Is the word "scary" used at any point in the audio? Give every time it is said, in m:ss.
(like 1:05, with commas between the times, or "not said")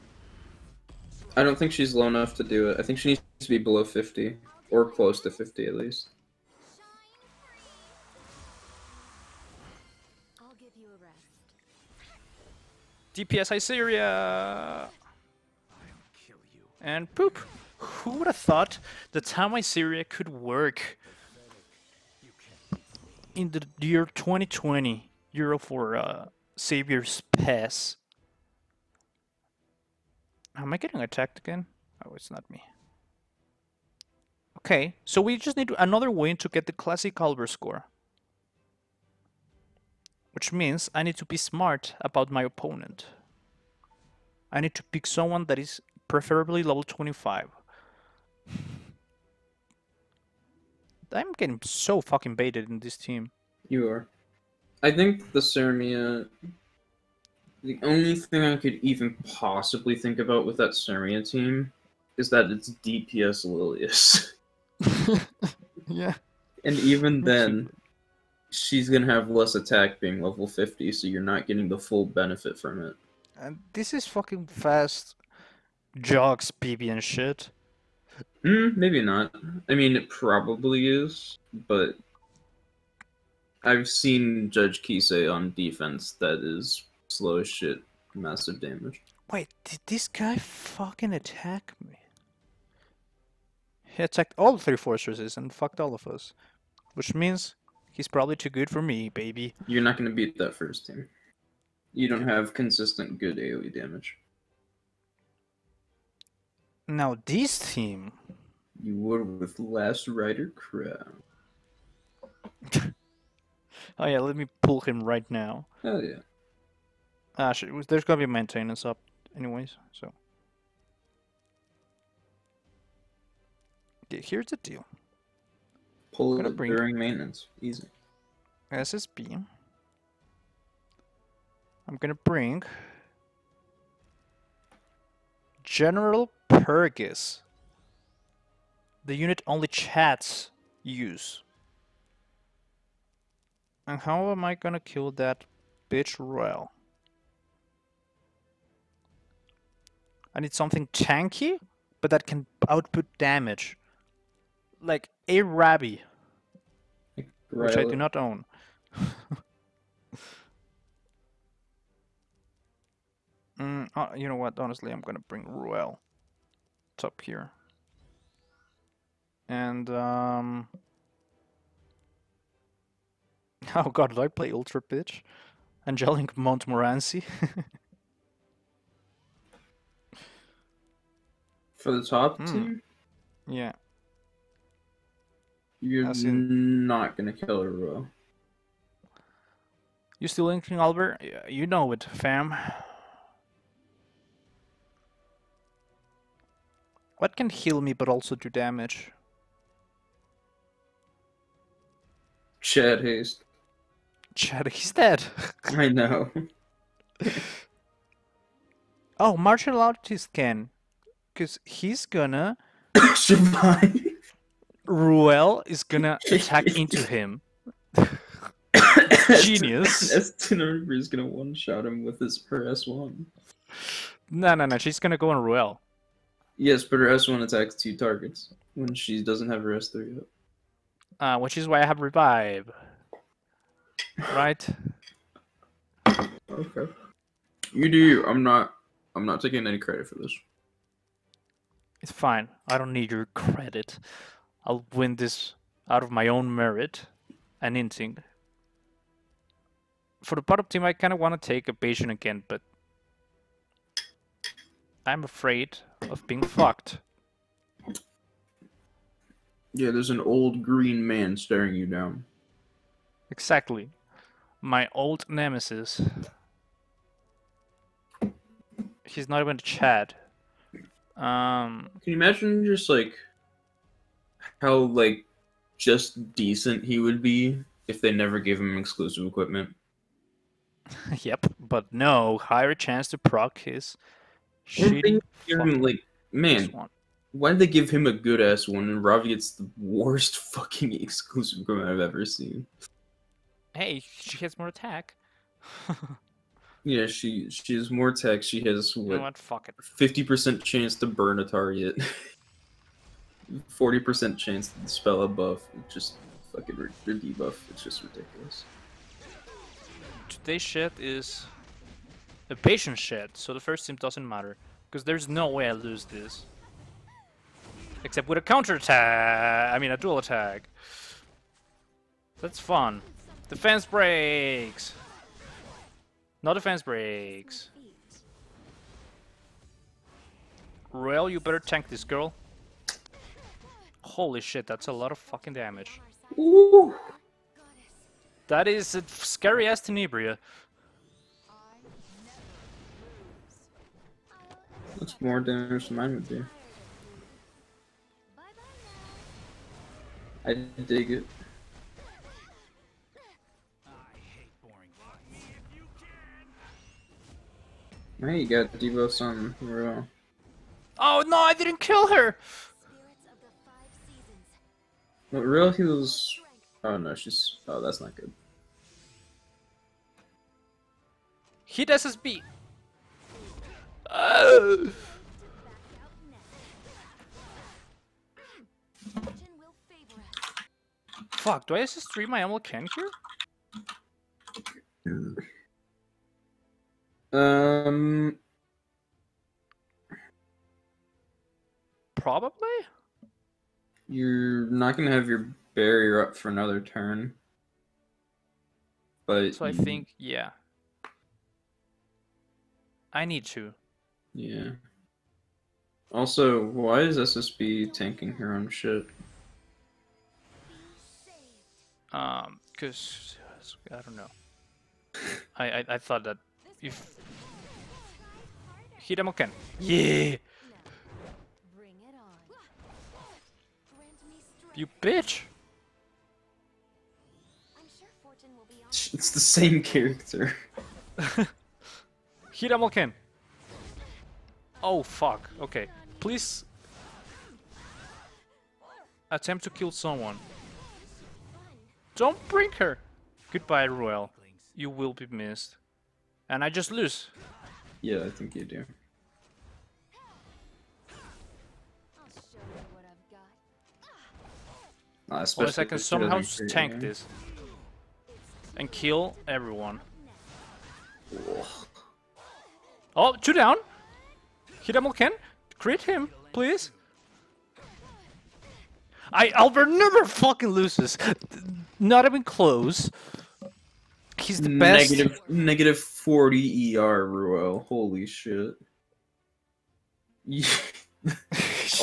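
5:39.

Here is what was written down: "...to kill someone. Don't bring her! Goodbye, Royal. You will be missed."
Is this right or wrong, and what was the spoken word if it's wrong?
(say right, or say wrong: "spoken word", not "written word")
right.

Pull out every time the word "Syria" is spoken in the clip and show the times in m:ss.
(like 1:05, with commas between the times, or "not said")
0:19.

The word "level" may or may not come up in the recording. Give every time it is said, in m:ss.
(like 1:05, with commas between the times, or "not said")
0:46, 1:10.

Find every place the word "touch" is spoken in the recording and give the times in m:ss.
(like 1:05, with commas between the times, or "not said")
not said.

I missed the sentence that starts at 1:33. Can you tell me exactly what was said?
He attacked all three fortresses and fucked all of us.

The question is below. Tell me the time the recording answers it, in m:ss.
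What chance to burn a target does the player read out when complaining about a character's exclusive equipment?
4:59.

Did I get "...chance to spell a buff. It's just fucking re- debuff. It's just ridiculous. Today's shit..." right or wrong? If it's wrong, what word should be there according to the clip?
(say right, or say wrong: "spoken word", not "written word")
right.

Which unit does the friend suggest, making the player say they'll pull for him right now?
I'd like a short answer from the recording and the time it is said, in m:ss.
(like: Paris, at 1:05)
Last Rider Krau, at 1:49.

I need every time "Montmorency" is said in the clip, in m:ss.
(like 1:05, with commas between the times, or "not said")
2:56.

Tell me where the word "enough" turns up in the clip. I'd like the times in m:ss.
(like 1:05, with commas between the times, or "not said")
0:02.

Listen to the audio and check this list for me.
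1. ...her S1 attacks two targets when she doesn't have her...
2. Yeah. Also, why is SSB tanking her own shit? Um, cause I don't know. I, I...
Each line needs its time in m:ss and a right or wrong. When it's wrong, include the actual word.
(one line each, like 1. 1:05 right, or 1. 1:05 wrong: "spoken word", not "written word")
1. 3:46 right
2. 6:44 right.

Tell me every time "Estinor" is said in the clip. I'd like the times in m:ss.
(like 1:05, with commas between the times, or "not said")
3:40.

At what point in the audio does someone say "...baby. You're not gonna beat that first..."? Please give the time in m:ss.
1:39.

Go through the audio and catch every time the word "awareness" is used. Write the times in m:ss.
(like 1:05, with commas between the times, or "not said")
not said.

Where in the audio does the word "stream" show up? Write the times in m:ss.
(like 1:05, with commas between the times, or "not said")
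6:22.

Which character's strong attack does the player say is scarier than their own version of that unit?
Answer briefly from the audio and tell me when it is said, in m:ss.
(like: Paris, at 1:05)
Tenebria, at 5:39.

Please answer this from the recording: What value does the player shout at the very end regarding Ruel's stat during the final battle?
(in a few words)
-40 ER.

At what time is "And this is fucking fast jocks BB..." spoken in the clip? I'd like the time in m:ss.
1:13.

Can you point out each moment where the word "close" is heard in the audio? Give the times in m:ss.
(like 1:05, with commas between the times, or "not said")
0:04, 7:52.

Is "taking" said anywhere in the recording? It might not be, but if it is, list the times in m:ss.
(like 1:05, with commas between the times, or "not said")
3:59.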